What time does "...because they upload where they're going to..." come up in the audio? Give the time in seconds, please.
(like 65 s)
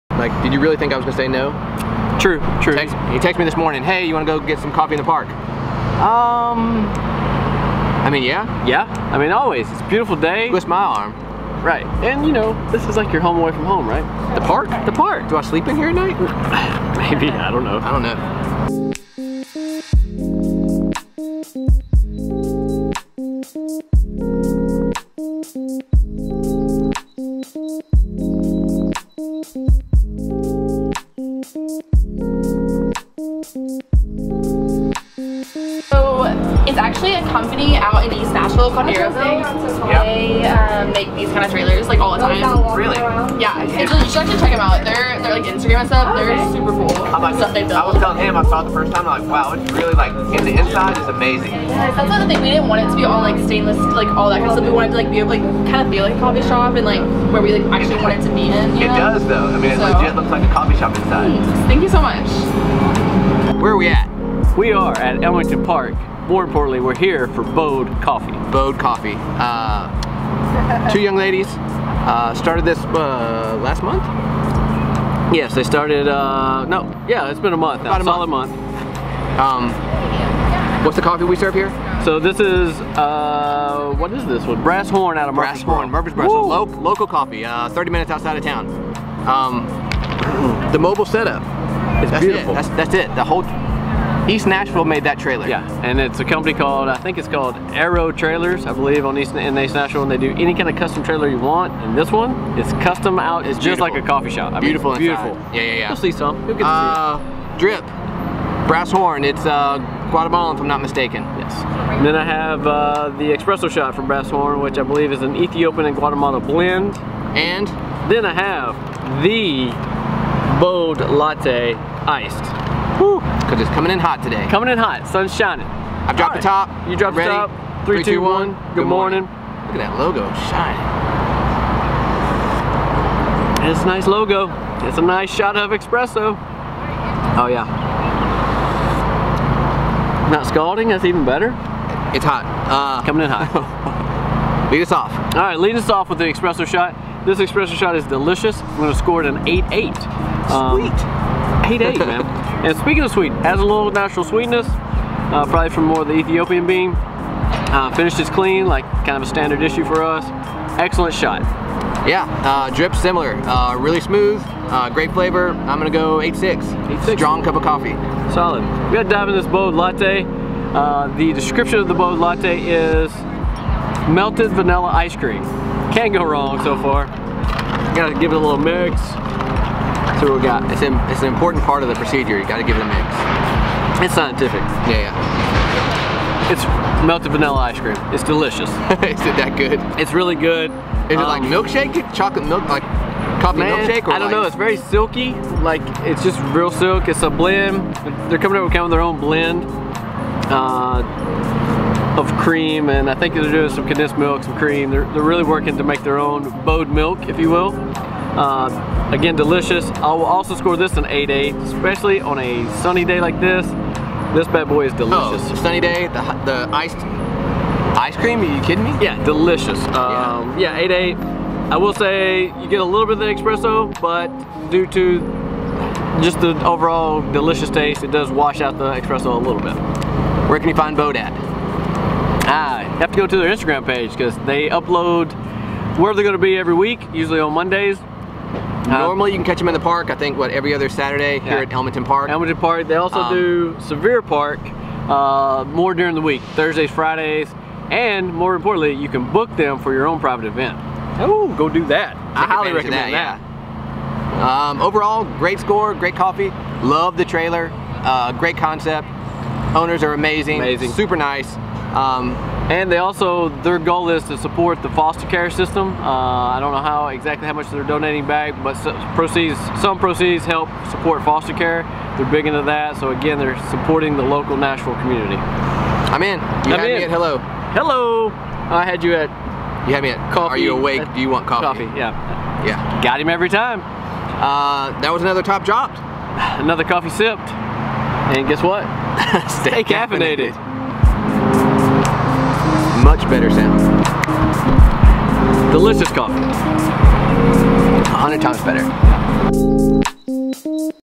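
234 s.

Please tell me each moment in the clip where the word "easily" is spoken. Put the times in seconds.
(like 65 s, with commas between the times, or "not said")
not said.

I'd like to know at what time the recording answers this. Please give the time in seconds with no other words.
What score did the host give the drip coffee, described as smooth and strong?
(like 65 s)
166 s.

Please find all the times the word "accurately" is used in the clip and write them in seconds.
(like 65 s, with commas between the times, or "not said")
not said.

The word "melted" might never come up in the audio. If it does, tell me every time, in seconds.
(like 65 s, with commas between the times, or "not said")
174 s, 187 s.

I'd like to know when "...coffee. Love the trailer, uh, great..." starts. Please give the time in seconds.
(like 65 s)
256 s.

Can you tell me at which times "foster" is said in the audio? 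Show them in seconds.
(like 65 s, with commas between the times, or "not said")
264 s, 271 s.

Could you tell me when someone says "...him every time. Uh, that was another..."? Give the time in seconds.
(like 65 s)
283 s.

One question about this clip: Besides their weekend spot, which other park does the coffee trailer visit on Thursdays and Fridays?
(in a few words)
Sevier Park.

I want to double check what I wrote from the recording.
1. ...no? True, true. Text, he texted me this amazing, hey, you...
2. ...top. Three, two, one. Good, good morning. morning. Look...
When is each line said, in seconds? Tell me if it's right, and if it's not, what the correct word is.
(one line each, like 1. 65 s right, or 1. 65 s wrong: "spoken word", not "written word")
1. 1 s wrong: "morning", not "amazing"
2. 127 s right.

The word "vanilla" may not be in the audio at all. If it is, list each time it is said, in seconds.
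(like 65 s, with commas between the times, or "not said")
174 s, 187 s.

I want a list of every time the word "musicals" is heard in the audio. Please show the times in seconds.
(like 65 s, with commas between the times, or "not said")
not said.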